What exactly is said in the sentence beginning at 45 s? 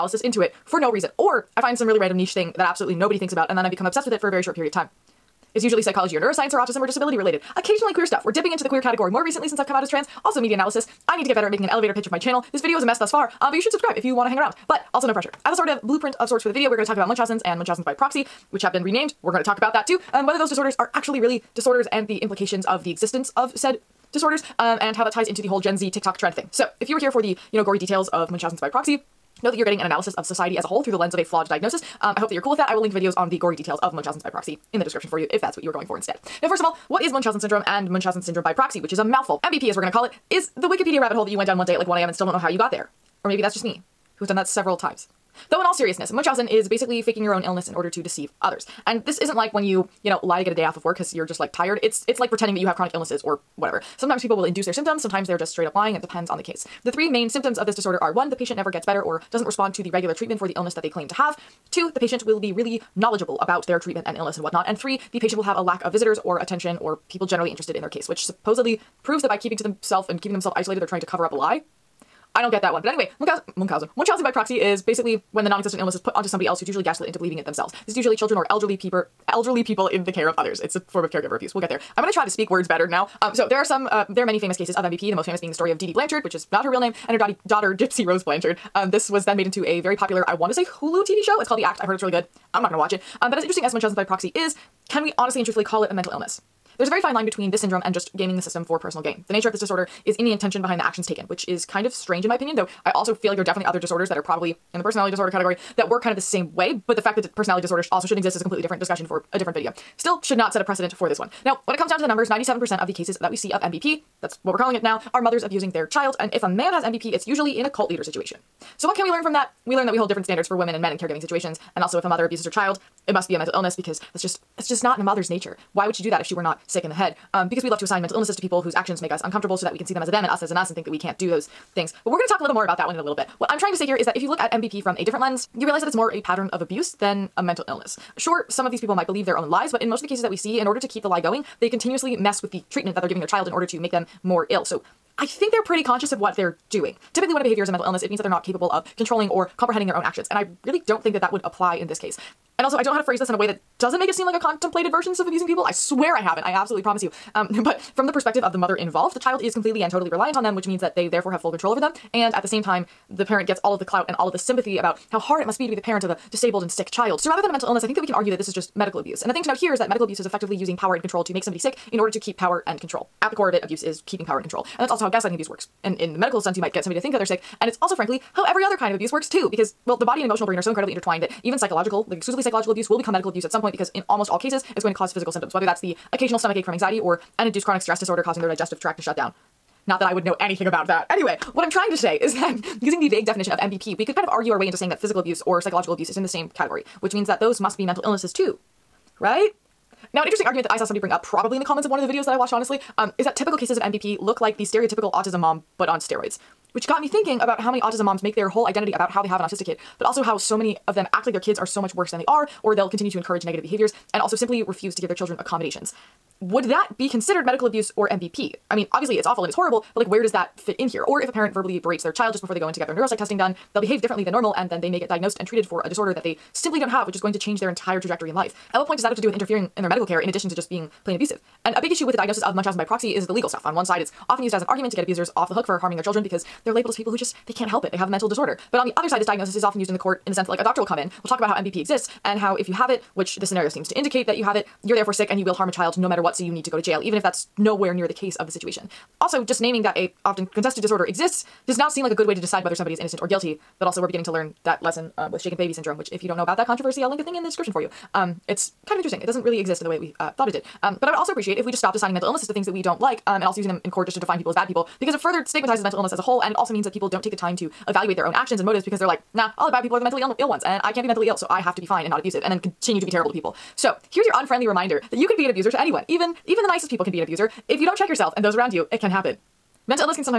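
Though in all seriousness, Munchausen is basically faking your own illness in order to deceive others.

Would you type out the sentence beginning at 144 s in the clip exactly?
So I think they're pretty conscious of what they're doing.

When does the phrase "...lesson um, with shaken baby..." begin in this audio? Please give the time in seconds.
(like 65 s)
254 s.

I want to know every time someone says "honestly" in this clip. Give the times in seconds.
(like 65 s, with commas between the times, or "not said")
95 s, 202 s.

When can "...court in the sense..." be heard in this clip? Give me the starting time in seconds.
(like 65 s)
239 s.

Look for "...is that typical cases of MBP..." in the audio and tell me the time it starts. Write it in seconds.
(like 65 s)
203 s.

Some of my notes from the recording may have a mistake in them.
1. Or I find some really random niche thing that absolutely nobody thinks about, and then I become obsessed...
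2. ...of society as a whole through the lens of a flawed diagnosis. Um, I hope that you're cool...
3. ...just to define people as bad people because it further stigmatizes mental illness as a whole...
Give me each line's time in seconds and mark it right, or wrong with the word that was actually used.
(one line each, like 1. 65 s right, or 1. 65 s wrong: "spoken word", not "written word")
1. 1 s right
2. 30 s right
3. 264 s right.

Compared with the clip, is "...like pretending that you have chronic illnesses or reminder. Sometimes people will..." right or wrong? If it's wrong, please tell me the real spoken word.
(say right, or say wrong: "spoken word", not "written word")
wrong: "whatever", not "reminder".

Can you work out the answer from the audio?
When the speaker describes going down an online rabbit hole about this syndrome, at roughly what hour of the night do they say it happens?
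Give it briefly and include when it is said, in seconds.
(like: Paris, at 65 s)
1am, at 41 s.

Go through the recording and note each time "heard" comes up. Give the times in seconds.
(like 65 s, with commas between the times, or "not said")
91 s.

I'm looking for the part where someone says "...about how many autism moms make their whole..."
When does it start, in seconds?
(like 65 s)
207 s.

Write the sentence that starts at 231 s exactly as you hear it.
And a big issue with the diagnosis of Munchausen by proxy is the legal stuff.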